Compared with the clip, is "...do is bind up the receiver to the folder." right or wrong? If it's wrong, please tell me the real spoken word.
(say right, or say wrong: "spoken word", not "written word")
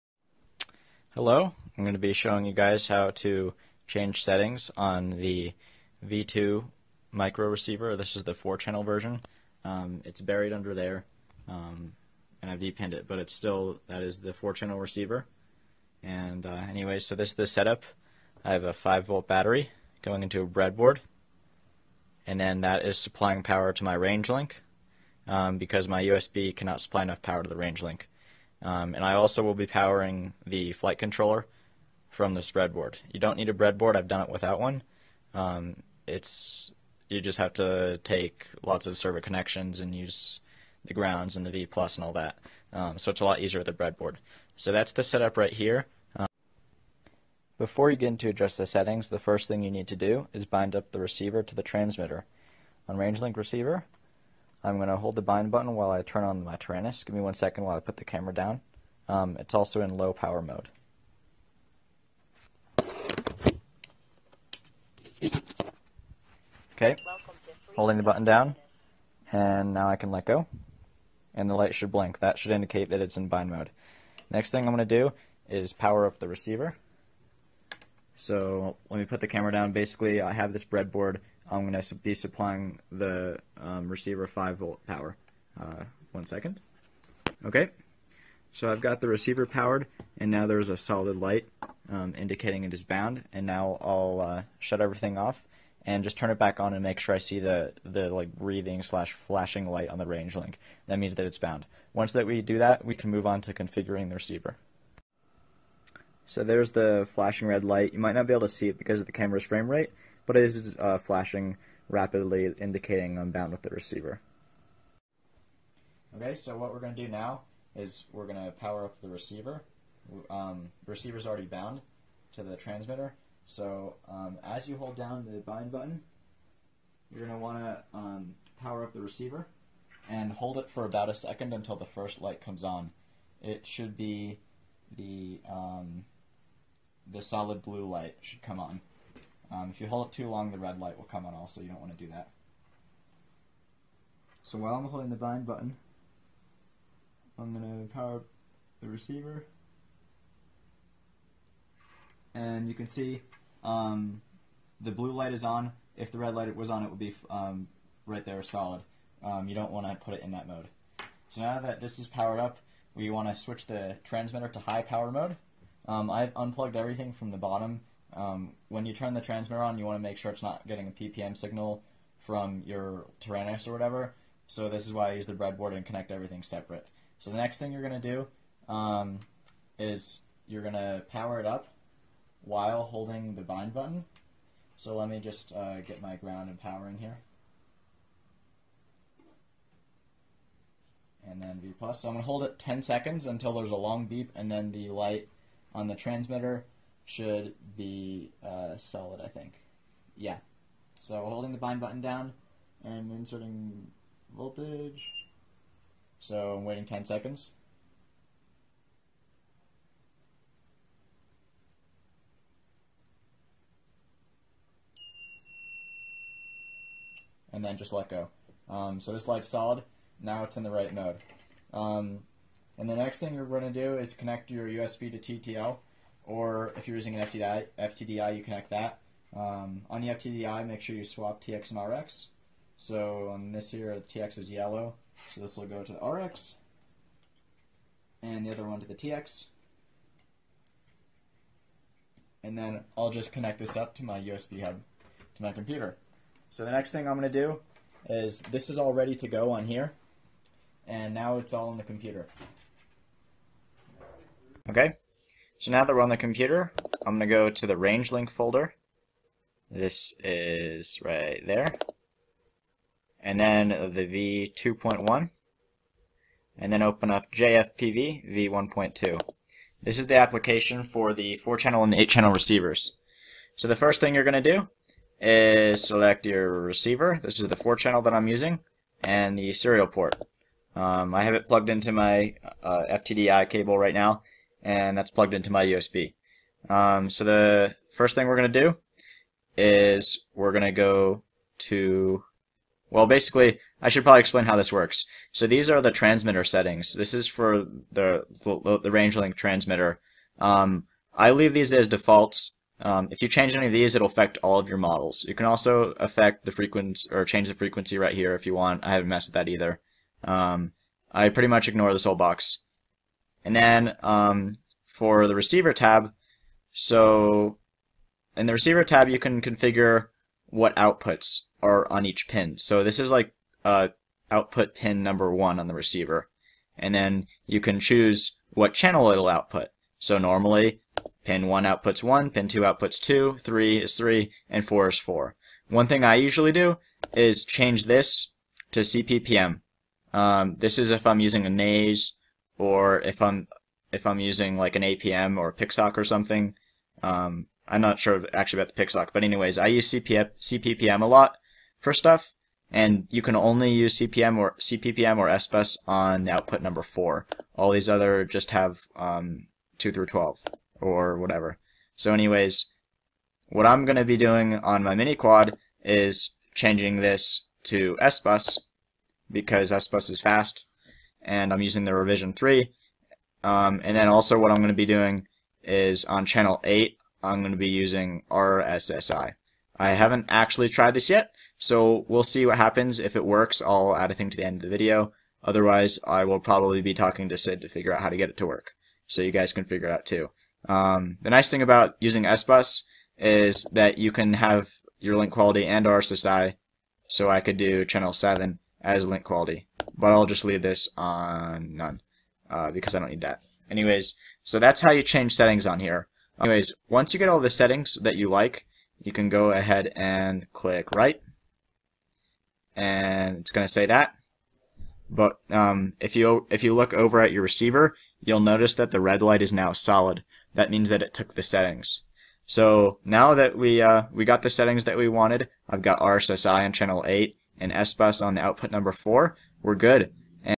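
wrong: "transmitter", not "folder".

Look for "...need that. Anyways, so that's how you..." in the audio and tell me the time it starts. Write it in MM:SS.
06:43.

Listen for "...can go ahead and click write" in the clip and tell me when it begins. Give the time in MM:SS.
06:49.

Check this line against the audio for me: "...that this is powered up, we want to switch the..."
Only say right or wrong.
right.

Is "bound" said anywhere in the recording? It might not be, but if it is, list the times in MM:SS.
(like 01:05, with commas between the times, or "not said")
01:32, 01:41, 01:53, 02:01.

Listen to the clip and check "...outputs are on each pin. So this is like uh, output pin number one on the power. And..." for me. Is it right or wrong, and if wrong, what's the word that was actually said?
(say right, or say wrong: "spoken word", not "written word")
wrong: "receiver", not "power".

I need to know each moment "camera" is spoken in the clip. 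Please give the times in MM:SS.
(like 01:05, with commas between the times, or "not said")
00:58, 01:19, 01:49.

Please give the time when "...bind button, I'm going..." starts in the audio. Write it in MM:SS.
02:25.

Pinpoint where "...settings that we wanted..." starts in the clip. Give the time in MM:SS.
07:04.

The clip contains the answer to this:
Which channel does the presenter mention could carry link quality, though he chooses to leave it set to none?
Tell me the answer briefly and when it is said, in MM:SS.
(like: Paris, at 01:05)
Channel 7, at 06:37.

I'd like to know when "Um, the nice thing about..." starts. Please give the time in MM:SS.
06:30.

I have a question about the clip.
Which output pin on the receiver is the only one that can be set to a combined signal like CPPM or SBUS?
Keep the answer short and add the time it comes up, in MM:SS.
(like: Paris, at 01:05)
Output number 4, at 05:56.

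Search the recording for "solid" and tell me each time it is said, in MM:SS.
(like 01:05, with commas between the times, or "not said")
01:30, 02:17, 02:38, 03:18, 03:39, 06:59.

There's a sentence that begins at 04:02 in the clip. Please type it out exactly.
And then I'll just connect this up to my USB hub, to my computer.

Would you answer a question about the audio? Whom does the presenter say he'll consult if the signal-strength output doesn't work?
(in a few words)
Sid.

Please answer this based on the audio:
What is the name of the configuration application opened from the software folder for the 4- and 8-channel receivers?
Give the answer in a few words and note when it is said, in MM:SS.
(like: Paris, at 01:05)
JFPV v1.2, at 04:27.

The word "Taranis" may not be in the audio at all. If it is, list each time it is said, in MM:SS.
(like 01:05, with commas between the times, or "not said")
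00:56, 02:53.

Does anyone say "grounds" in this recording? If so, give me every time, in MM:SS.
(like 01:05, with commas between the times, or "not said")
00:40, 03:06.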